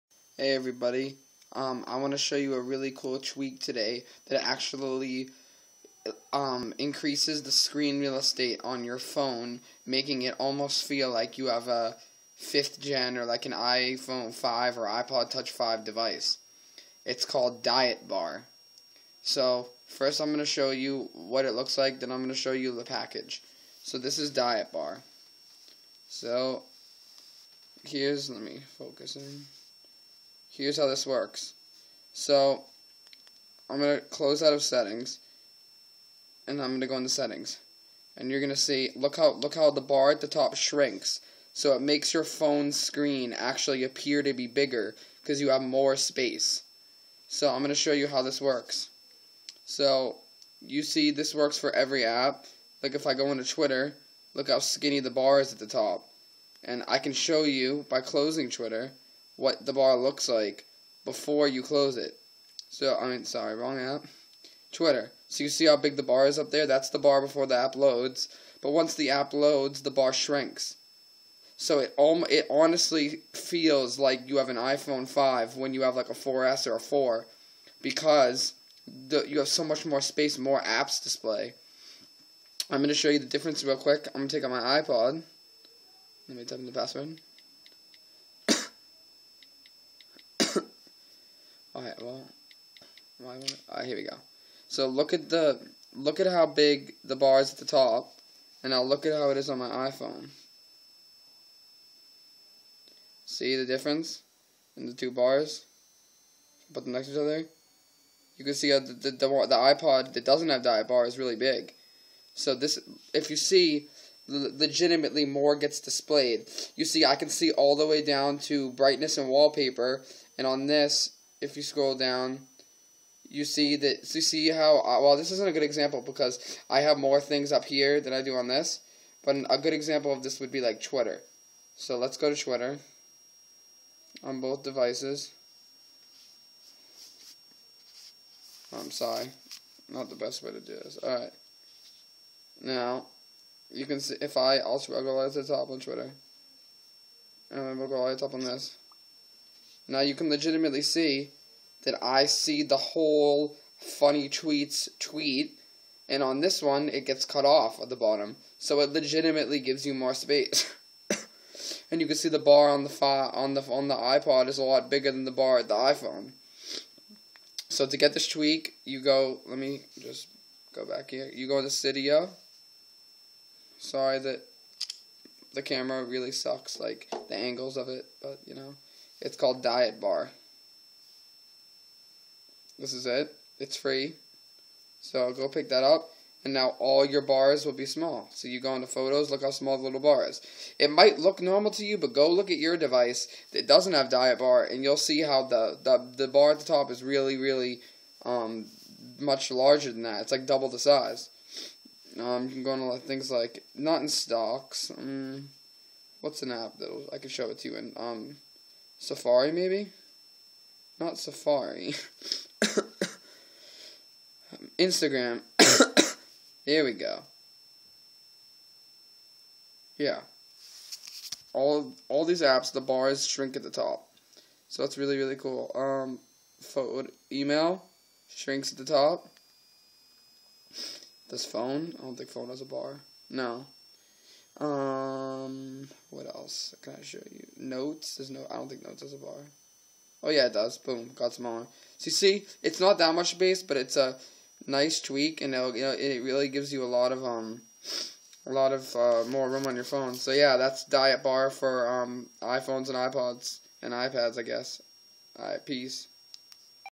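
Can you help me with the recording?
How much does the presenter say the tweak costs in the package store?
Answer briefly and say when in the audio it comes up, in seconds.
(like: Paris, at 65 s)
Free, at 183 s.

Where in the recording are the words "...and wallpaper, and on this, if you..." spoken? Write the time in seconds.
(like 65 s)
119 s.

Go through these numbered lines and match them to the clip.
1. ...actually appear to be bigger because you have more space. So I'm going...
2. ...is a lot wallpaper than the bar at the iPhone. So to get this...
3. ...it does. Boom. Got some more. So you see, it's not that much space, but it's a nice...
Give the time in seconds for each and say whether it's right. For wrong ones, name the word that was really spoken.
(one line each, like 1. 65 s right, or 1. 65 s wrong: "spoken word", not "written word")
1. 43 s right
2. 164 s wrong: "bigger", not "wallpaper"
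3. 240 s right.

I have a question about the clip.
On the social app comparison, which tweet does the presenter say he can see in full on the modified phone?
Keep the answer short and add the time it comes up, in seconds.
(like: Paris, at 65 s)
funny tweets, at 152 s.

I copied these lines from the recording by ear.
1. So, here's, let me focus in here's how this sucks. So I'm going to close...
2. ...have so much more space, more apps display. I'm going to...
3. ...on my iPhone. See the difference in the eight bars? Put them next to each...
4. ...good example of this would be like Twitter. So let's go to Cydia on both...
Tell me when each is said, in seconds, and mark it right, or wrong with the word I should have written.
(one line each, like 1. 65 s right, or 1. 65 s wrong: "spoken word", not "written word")
1. 26 s wrong: "works", not "sucks"
2. 79 s right
3. 99 s wrong: "two", not "eight"
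4. 129 s wrong: "Twitter", not "Cydia".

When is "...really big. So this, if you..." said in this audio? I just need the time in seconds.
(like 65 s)
111 s.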